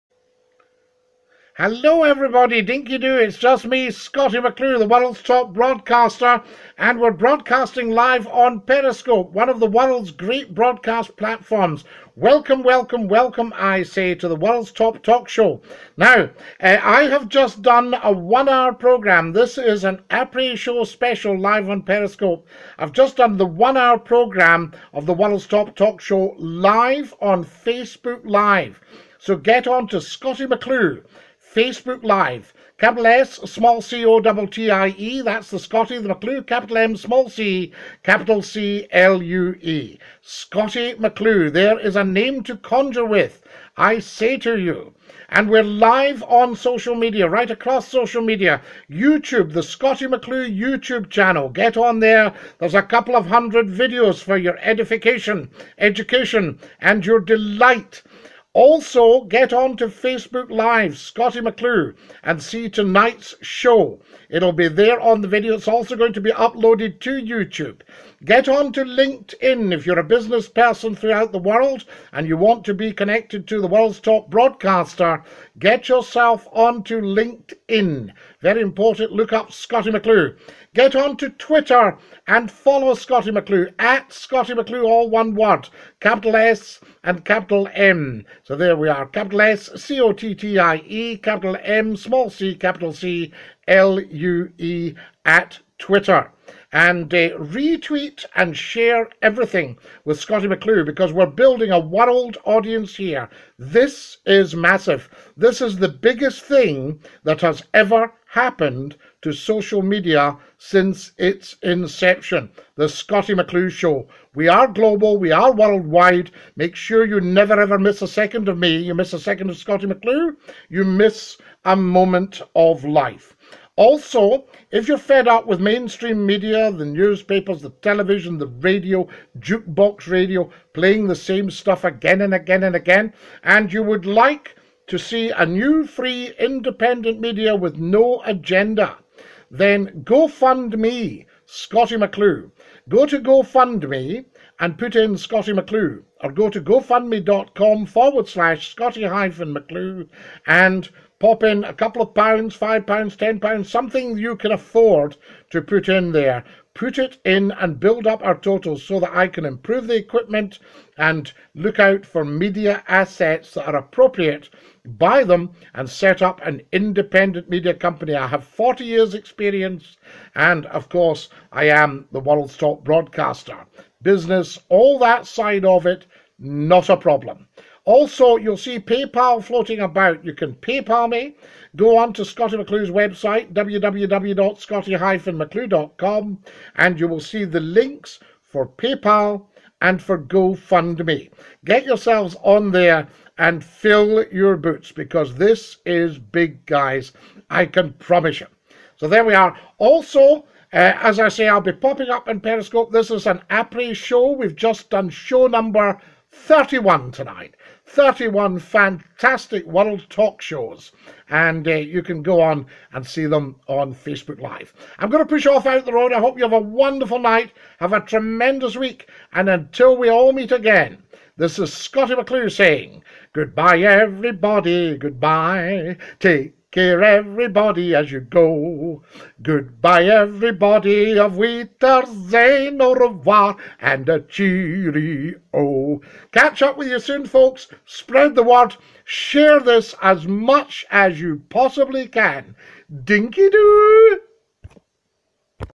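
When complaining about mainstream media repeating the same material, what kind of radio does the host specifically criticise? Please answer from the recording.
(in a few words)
jukebox radio.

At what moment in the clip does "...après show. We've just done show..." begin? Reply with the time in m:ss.
3:23.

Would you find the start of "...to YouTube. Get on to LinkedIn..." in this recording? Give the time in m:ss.
1:06.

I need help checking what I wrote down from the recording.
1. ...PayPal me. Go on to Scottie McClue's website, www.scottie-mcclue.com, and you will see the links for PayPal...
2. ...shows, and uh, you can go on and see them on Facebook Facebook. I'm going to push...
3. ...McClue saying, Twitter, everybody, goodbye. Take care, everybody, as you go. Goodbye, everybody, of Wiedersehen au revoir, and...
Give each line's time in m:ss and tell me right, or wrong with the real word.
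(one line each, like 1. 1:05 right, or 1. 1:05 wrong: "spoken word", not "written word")
1. 3:00 right
2. 3:30 wrong: "Live", not "Facebook"
3. 3:42 wrong: "Goodbye", not "Twitter".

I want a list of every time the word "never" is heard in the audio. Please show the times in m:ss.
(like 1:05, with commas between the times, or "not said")
1:57.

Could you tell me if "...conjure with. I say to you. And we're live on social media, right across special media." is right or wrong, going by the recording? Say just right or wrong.
wrong.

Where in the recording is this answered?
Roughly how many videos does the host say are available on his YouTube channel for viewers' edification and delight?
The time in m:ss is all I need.
0:52.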